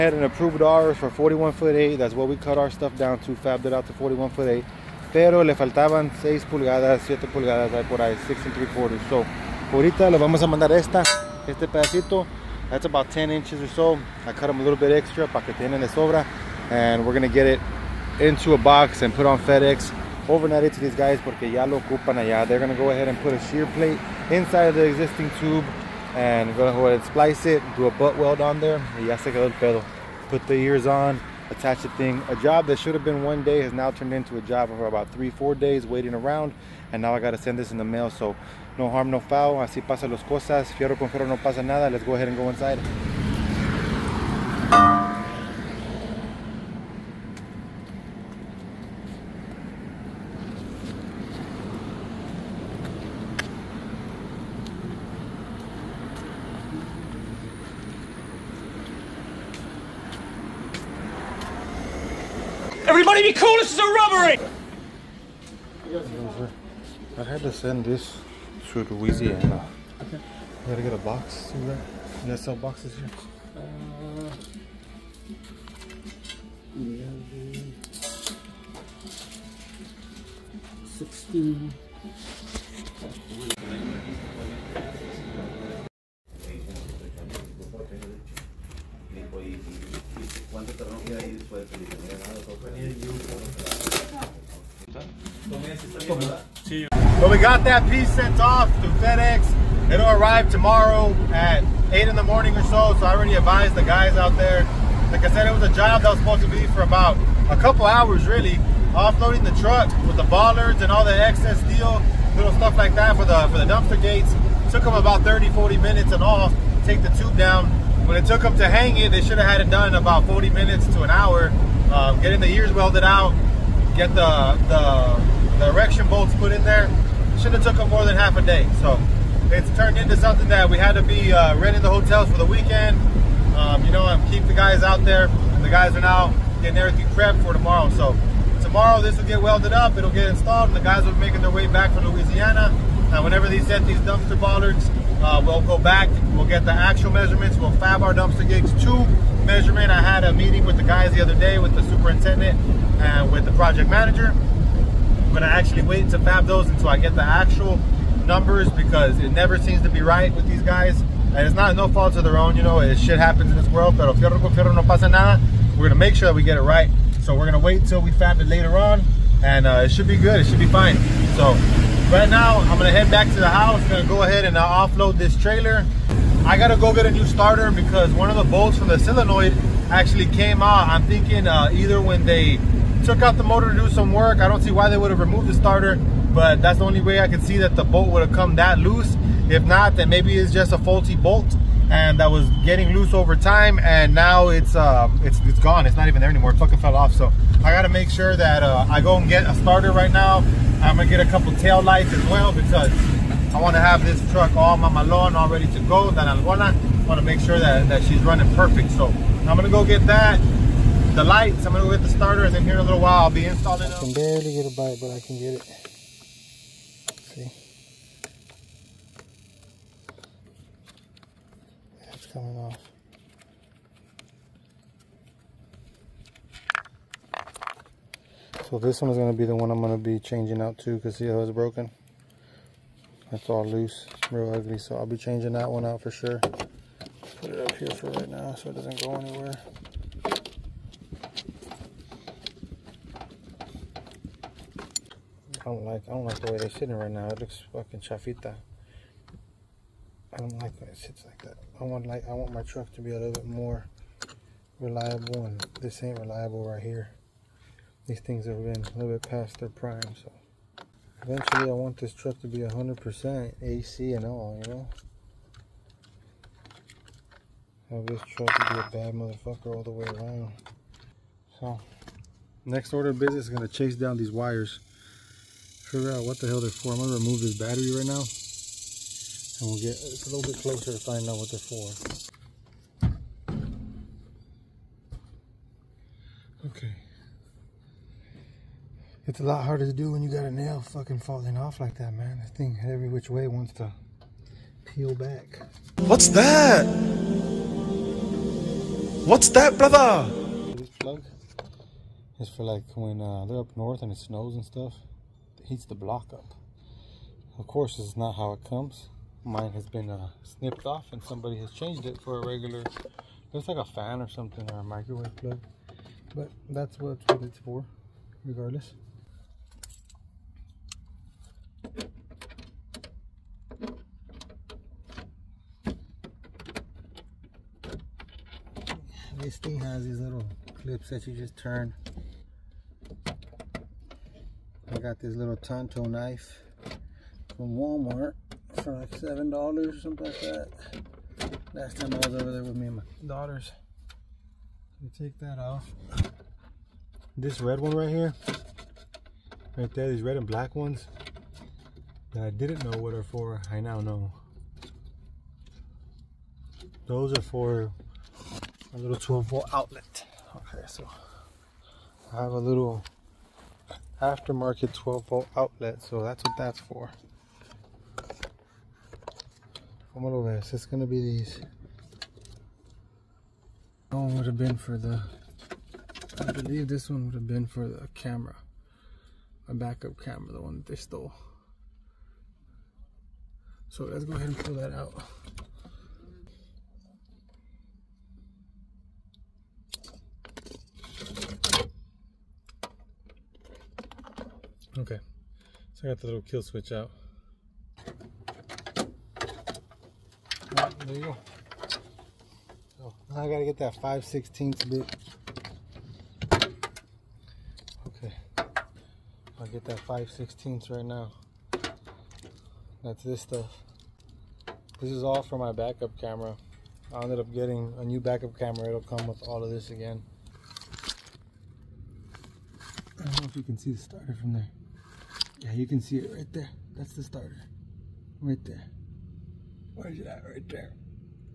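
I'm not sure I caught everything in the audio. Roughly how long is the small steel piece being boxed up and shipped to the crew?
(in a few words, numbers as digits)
10 inches.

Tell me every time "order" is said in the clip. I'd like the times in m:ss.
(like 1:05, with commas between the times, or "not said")
4:32.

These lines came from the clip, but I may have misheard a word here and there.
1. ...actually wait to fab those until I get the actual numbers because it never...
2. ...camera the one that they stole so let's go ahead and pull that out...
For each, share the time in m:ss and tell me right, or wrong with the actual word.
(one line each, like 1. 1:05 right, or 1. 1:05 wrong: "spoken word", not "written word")
1. 2:35 right
2. 6:20 right.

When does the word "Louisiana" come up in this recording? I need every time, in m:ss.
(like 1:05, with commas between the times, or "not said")
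1:08, 2:22.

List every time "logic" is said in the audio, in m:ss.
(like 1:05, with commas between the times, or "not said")
not said.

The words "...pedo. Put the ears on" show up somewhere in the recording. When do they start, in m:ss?
0:29.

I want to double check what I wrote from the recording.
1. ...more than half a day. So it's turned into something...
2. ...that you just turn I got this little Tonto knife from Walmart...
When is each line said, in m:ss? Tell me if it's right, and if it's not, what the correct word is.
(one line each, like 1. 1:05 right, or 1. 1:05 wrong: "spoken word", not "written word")
1. 2:07 right
2. 5:31 right.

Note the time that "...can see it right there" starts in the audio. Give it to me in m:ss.
7:05.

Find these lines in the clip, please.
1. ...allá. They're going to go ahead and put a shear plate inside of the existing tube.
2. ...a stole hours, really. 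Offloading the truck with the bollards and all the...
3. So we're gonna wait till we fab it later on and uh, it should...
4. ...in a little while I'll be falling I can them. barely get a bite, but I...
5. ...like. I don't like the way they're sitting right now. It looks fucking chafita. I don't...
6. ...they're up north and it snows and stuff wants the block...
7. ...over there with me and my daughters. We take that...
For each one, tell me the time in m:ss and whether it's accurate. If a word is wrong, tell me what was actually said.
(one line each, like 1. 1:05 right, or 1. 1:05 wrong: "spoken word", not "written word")
1. 0:22 right
2. 1:47 wrong: "couple", not "stole"
3. 2:47 right
4. 3:32 wrong: "installing", not "falling"
5. 4:05 right
6. 5:03 wrong: "heats", not "wants"
7. 5:42 right.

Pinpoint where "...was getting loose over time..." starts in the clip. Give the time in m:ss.
3:12.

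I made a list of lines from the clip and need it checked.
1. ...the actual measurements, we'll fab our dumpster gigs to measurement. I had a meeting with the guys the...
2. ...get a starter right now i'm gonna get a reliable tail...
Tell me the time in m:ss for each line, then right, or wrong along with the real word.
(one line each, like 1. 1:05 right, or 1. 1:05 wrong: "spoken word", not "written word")
1. 2:26 right
2. 3:19 wrong: "couple", not "reliable".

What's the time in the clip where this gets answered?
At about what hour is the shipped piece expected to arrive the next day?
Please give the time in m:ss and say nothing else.
1:41.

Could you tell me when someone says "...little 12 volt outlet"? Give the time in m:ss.
5:58.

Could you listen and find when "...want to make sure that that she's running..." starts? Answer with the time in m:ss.
3:27.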